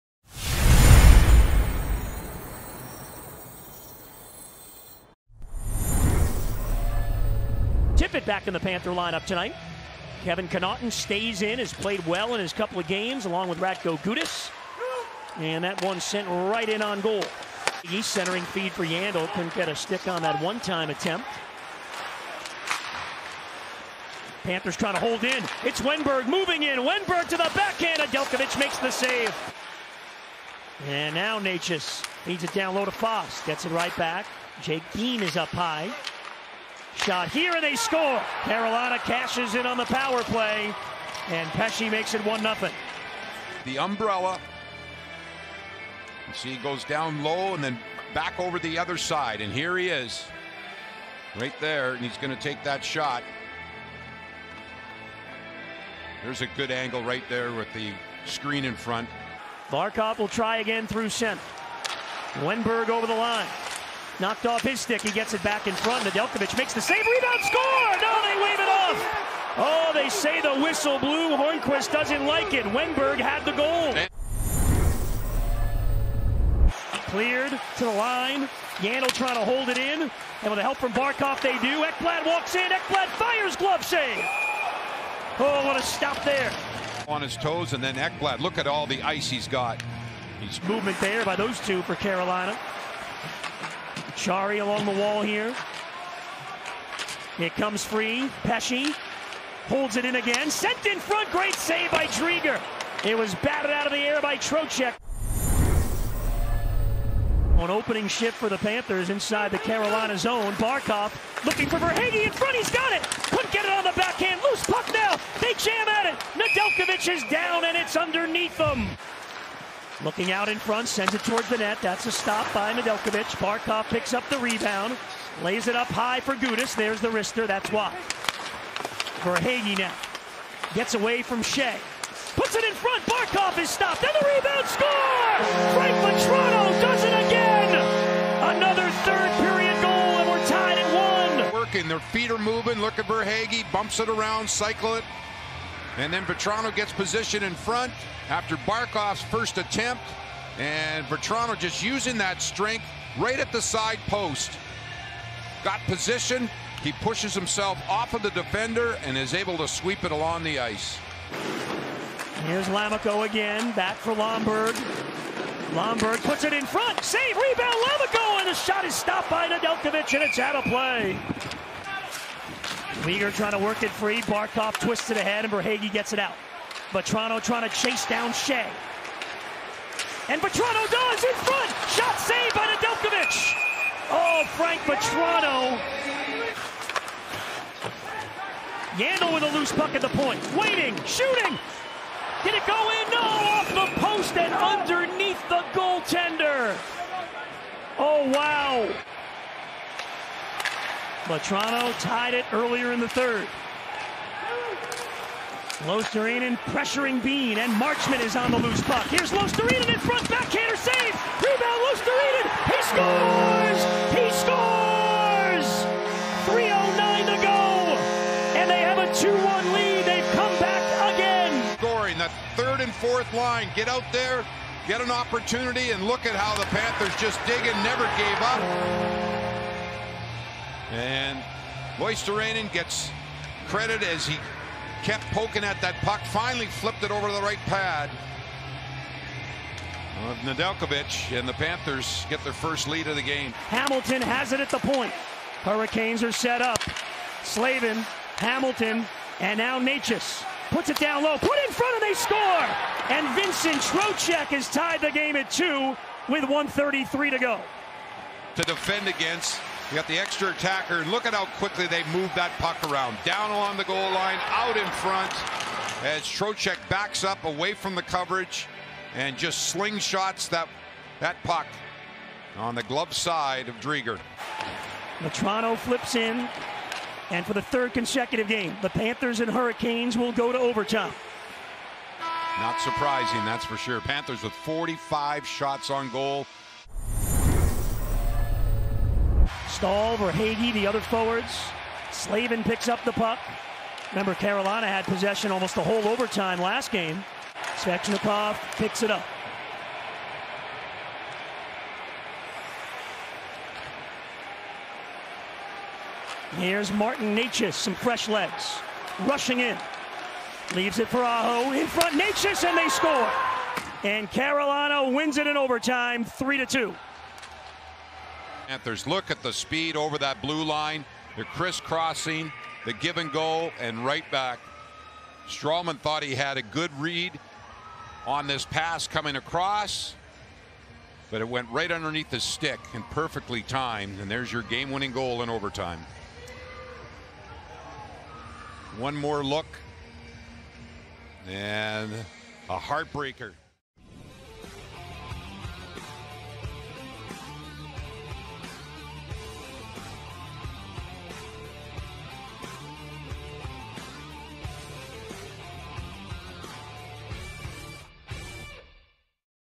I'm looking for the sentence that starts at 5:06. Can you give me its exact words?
Here's Martin Necas, some fresh legs, rushing in.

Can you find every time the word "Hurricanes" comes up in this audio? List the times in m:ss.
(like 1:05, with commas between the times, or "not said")
4:05, 4:39.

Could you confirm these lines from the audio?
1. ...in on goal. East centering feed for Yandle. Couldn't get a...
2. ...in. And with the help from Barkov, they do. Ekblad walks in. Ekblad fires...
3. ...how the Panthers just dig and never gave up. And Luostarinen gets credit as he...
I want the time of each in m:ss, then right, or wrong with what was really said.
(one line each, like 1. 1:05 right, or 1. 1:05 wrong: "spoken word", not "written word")
1. 0:16 right
2. 1:19 right
3. 3:46 right.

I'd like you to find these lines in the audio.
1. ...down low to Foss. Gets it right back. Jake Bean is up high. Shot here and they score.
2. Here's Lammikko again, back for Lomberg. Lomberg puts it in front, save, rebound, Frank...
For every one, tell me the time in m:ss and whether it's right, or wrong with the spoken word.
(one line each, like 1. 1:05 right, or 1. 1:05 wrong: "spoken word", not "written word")
1. 0:32 right
2. 2:42 wrong: "Lammikko", not "Frank".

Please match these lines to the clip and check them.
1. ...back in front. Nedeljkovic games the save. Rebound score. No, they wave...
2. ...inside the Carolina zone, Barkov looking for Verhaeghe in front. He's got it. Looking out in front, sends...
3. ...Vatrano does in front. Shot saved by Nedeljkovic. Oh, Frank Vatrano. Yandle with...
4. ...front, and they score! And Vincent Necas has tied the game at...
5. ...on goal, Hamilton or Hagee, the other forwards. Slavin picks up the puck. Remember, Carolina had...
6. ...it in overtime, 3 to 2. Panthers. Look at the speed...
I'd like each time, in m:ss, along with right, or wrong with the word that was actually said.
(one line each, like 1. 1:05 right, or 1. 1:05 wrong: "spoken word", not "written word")
1. 1:05 wrong: "makes", not "games"
2. 1:49 right
3. 3:00 right
4. 4:11 wrong: "Trocheck", not "Necas"
5. 4:45 wrong: "Staal", not "Hamilton"
6. 5:15 right.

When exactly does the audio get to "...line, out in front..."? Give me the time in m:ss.
4:24.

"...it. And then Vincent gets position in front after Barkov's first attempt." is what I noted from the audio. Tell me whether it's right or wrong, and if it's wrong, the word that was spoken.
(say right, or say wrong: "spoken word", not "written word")
wrong: "Vatrano", not "Vincent".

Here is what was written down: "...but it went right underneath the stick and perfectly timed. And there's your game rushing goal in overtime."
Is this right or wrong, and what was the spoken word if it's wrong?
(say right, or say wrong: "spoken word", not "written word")
wrong: "winning", not "rushing".